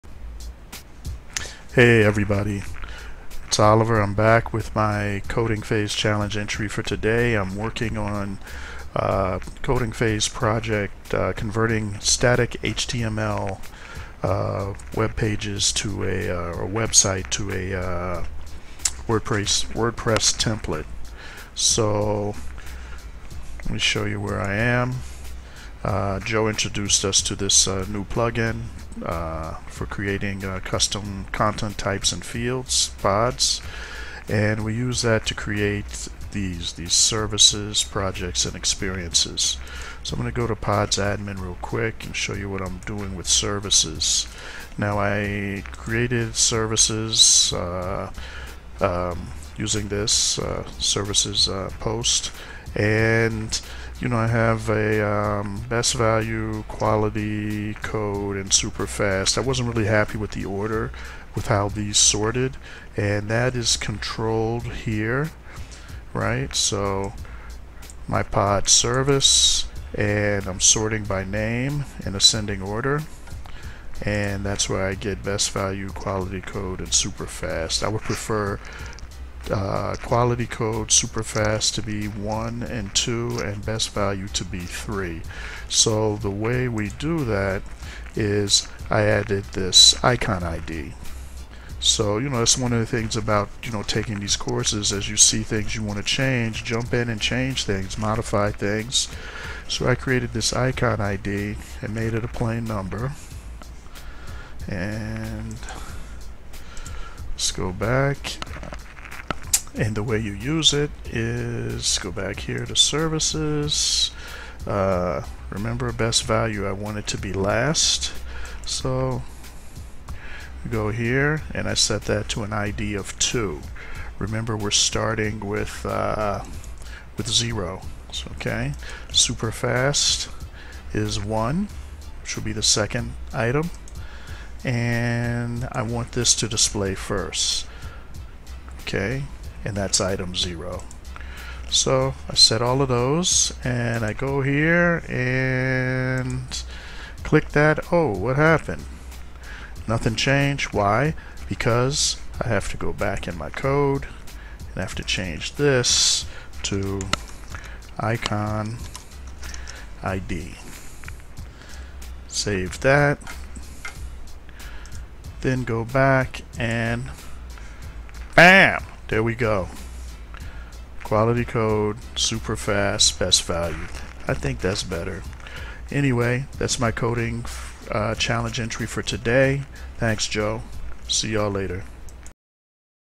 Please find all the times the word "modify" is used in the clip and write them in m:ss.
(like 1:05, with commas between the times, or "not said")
1:37.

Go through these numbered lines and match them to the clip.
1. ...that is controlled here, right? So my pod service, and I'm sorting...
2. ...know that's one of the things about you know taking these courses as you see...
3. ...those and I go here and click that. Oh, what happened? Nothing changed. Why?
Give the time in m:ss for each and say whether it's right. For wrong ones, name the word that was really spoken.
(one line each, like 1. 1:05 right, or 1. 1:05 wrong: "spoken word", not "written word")
1. 1:03 right
2. 1:32 right
3. 2:22 right.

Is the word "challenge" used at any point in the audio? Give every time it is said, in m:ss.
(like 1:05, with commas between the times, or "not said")
0:05, 2:58.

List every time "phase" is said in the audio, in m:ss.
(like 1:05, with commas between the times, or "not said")
0:05, 0:09.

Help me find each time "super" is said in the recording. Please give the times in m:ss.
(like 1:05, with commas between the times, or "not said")
0:58, 1:16, 1:20, 2:09, 2:52.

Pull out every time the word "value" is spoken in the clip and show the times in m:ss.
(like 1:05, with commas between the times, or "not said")
0:55, 1:15, 1:23, 1:56, 2:53.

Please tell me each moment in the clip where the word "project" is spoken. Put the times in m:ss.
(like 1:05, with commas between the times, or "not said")
0:10, 0:37.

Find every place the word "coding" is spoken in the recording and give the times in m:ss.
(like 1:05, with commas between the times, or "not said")
0:05, 0:09, 2:56.